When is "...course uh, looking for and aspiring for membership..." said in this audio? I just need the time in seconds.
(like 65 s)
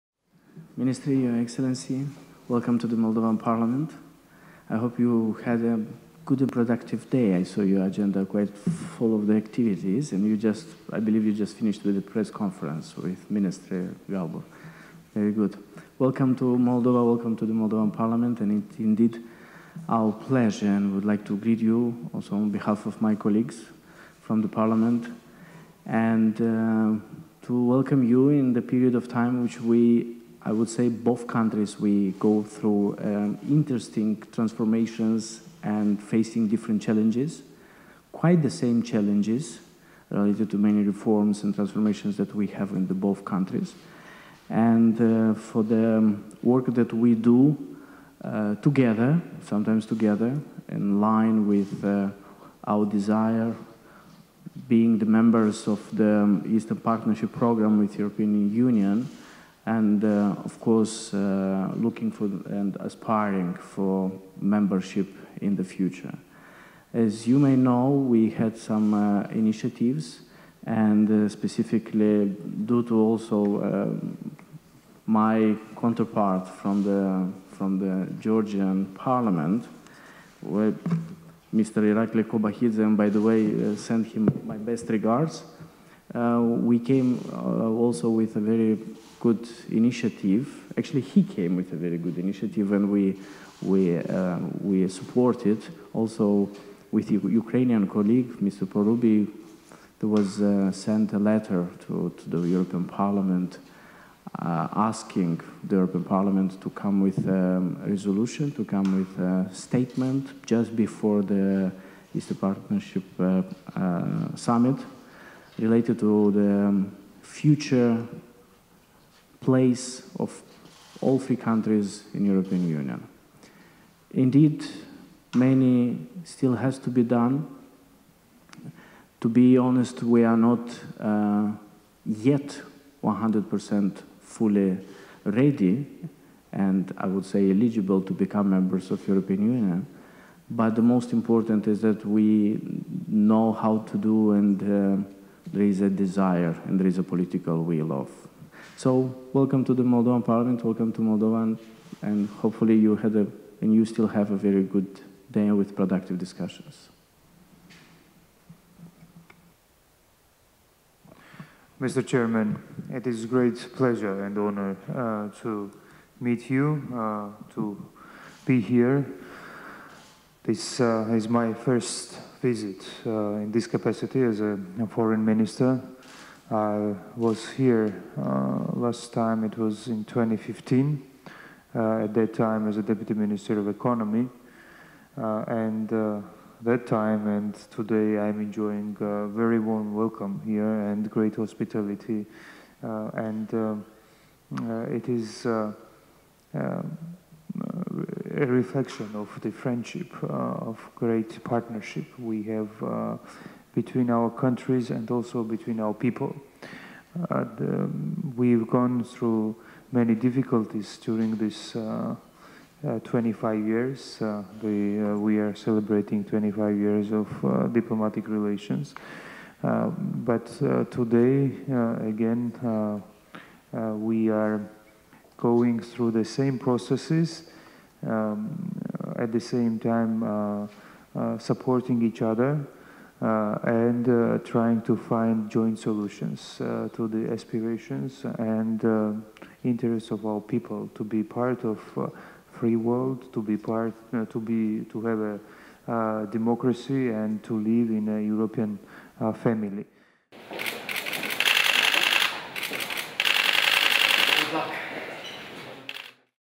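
60 s.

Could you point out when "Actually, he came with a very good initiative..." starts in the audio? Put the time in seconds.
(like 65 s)
90 s.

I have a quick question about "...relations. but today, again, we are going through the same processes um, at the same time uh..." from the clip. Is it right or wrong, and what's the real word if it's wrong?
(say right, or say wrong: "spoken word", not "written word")
right.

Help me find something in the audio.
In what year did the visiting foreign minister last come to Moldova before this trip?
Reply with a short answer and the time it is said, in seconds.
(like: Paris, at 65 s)
2015, at 180 s.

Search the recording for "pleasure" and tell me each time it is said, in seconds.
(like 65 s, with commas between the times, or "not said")
20 s, 163 s.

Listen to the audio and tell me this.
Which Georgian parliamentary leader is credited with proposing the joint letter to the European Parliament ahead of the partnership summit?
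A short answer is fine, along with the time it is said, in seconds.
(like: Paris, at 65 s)
Irakli Kobakhidze, at 81 s.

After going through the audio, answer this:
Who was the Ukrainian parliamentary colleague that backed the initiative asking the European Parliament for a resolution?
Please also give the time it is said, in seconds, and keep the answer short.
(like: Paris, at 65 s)
Parubiy, at 98 s.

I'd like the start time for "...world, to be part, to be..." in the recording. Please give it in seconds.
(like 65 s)
242 s.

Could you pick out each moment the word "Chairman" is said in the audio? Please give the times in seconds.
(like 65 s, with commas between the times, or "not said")
162 s.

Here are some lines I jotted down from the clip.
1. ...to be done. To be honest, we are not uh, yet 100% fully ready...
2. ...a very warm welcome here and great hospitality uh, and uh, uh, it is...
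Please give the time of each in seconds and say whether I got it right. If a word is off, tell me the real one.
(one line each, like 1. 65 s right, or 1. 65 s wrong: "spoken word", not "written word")
1. 126 s right
2. 188 s right.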